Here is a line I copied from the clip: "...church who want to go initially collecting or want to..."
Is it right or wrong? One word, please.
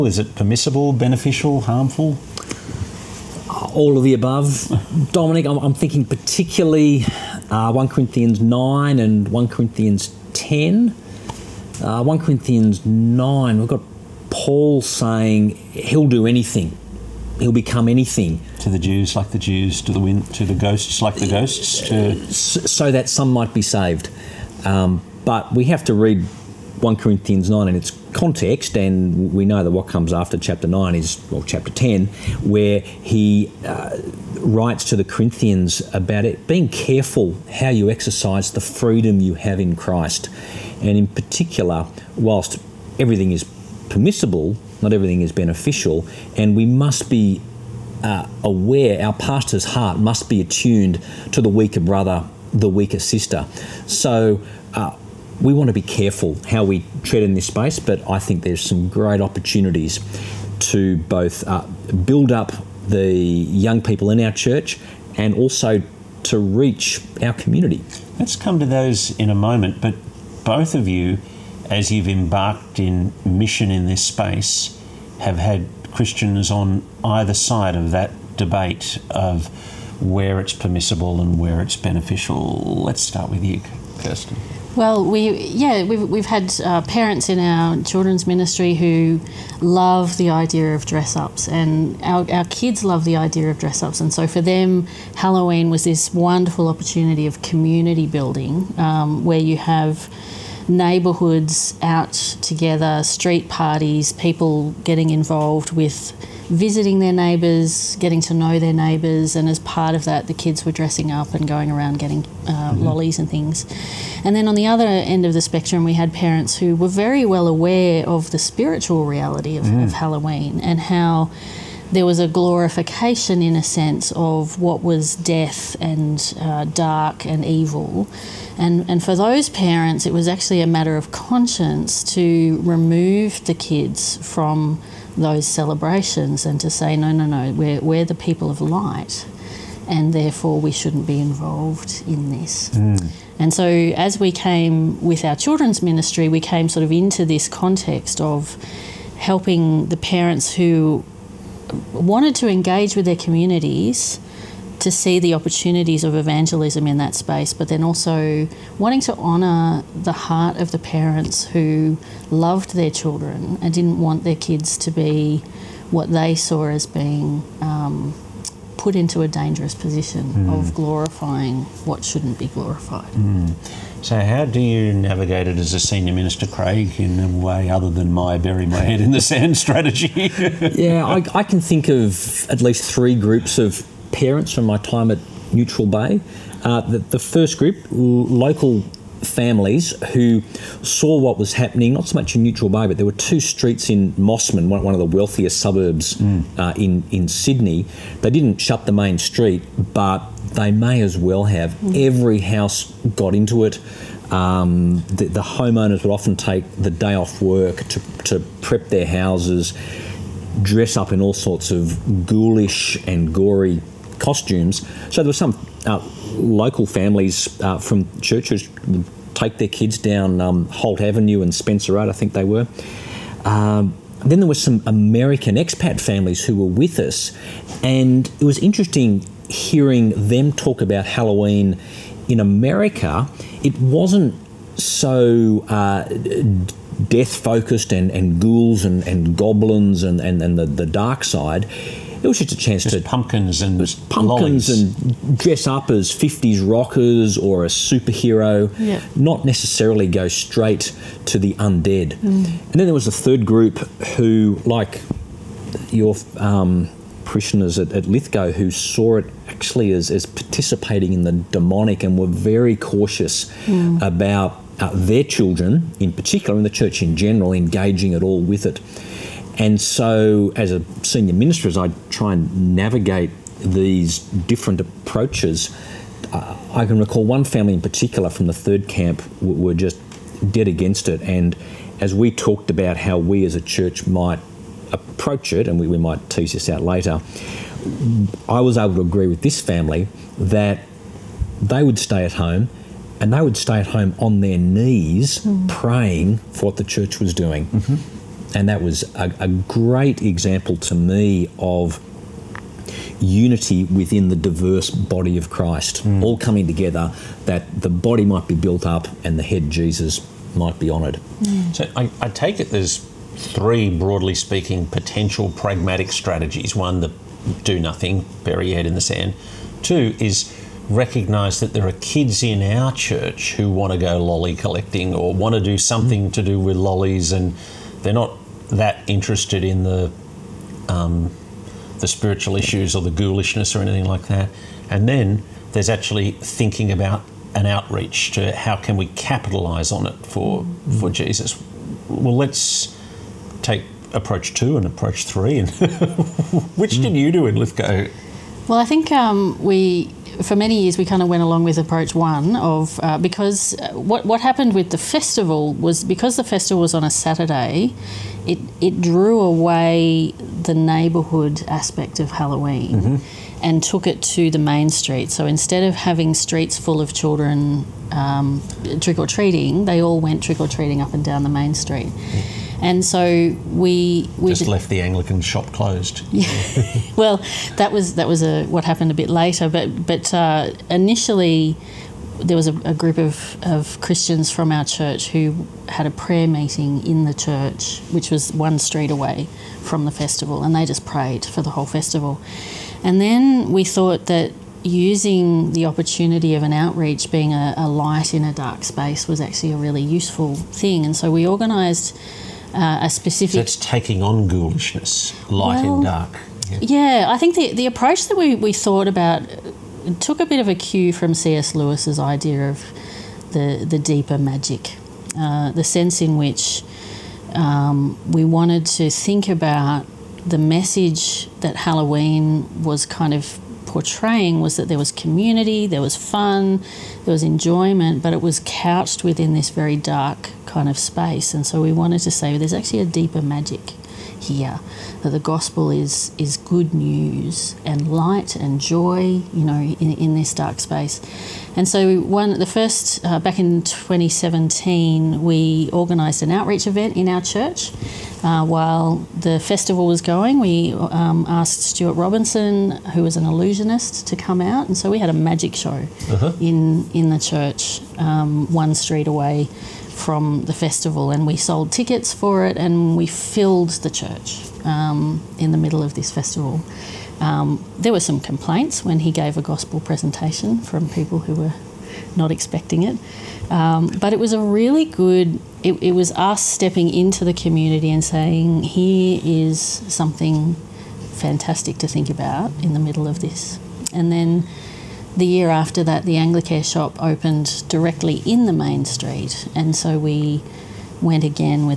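wrong.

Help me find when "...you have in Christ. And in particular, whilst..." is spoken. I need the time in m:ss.
0:39.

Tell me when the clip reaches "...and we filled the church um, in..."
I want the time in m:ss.
7:42.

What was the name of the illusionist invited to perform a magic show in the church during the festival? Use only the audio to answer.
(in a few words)
Stuart Robinson.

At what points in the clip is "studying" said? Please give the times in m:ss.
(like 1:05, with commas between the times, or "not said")
not said.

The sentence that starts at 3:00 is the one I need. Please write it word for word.
yeah, I, I, can think of at least three groups of parents from my time at Neutral Bay.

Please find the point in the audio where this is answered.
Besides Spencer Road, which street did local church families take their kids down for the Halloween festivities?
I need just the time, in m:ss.
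3:40.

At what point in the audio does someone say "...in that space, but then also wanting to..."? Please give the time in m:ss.
2:36.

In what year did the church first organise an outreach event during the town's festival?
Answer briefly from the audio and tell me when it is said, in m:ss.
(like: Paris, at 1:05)
2017, at 7:23.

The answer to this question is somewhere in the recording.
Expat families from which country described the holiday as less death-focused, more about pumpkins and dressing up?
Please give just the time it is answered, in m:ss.
3:52.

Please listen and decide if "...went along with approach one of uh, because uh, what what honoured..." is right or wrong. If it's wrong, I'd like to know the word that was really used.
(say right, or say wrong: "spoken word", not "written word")
wrong: "happened", not "honoured".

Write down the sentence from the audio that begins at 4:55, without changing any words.
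praying for what the church was doing.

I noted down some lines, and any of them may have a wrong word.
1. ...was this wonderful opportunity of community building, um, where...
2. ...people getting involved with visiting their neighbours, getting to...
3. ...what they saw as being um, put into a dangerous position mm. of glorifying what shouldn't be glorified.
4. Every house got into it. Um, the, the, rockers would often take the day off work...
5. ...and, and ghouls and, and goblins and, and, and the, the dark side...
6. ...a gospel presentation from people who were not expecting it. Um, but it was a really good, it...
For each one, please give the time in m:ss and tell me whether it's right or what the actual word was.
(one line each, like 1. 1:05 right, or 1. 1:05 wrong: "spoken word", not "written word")
1. 1:35 right
2. 1:44 right
3. 2:45 right
4. 3:22 wrong: "homeowners", not "rockers"
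5. 3:57 right
6. 7:49 right.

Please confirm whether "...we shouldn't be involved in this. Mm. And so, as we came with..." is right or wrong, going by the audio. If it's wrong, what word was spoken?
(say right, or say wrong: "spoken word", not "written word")
right.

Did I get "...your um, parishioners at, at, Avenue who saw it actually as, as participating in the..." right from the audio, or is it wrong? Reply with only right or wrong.
wrong.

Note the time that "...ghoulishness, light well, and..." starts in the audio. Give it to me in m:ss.
6:44.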